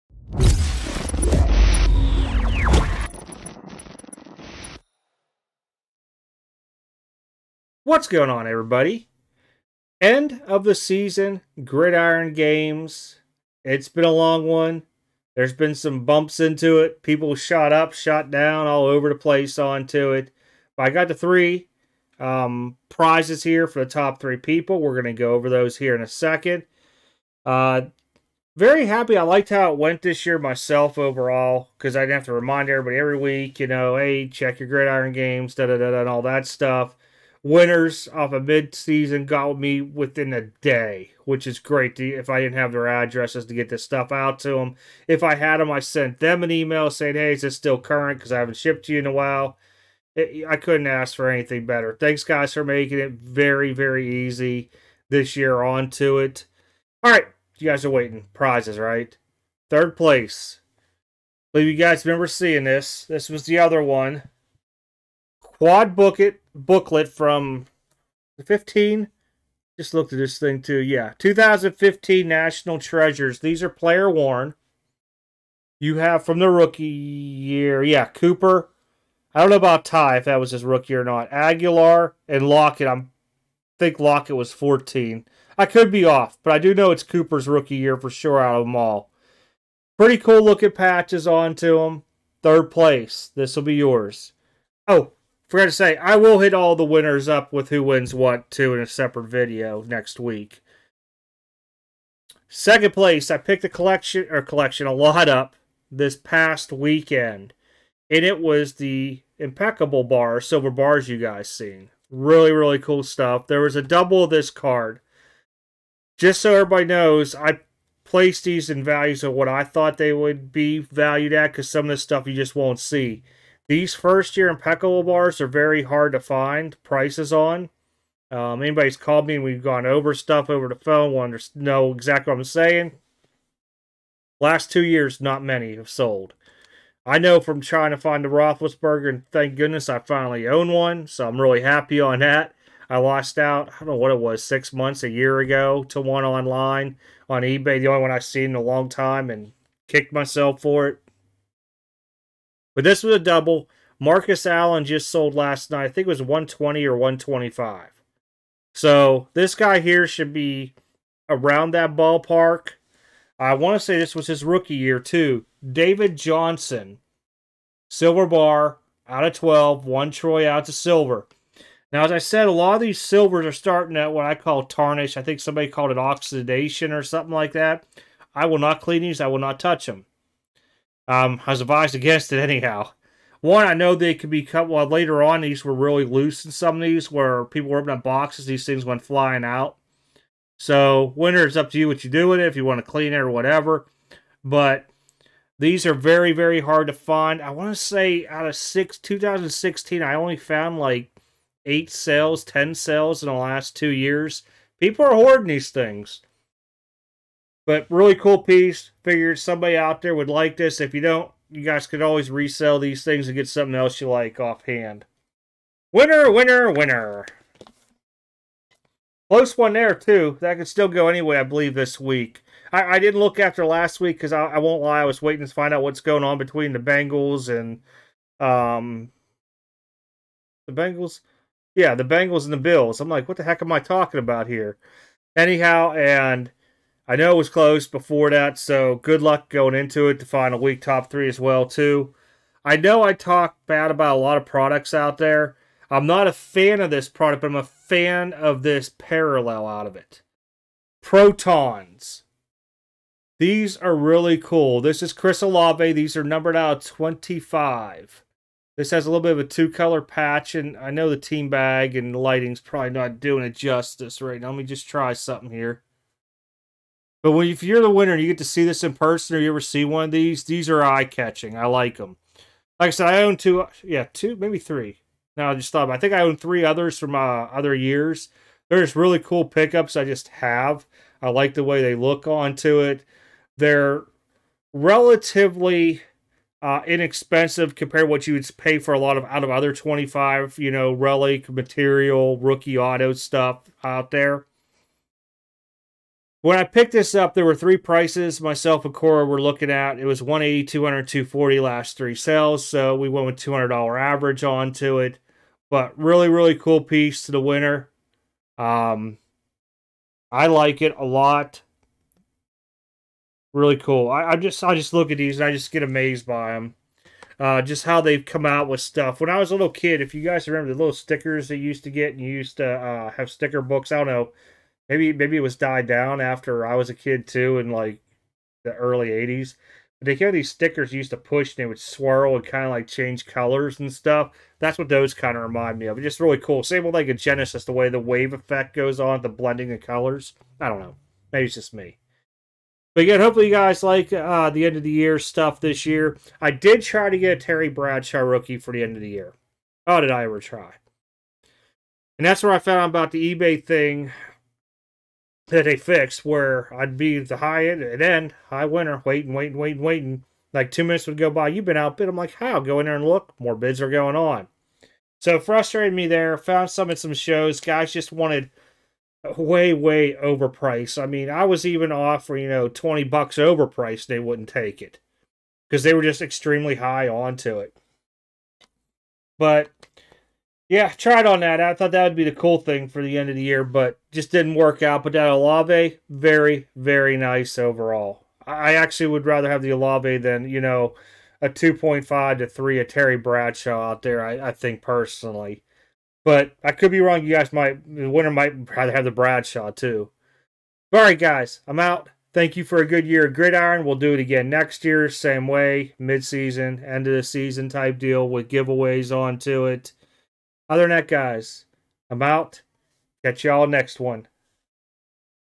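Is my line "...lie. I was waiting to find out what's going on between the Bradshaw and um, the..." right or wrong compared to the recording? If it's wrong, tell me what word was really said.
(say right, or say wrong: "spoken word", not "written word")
wrong: "Bengals", not "Bradshaw".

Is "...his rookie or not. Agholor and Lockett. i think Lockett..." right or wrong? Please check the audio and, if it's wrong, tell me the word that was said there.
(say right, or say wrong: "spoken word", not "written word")
right.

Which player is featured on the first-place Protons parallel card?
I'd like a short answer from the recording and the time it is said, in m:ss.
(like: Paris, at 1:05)
Chris Olave, at 4:15.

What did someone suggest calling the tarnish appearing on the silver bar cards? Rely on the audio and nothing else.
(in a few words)
oxidation.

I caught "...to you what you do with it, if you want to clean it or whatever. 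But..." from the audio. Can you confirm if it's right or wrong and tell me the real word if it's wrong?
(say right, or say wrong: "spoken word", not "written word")
right.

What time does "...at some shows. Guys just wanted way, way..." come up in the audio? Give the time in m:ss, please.
6:06.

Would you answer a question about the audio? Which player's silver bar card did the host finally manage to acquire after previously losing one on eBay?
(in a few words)
Roethlisberger.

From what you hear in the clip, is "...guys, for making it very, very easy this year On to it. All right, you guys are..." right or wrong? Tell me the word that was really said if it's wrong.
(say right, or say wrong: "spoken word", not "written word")
right.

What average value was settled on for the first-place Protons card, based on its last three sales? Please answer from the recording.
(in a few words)
$200.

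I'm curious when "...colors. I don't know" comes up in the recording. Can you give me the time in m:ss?
5:39.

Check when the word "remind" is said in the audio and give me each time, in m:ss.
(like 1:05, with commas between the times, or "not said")
0:32, 5:35.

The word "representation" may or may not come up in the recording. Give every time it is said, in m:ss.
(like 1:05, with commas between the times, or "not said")
not said.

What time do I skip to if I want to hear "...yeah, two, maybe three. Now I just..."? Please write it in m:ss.
4:33.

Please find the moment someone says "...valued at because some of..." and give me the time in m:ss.
2:00.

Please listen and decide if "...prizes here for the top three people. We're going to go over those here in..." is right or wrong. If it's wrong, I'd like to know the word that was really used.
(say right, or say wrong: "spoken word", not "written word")
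right.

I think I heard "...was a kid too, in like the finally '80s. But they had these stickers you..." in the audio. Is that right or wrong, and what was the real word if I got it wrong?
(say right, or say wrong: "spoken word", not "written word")
wrong: "early", not "finally".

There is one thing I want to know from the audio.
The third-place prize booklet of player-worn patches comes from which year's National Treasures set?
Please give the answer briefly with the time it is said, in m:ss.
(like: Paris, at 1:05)
2015, at 1:11.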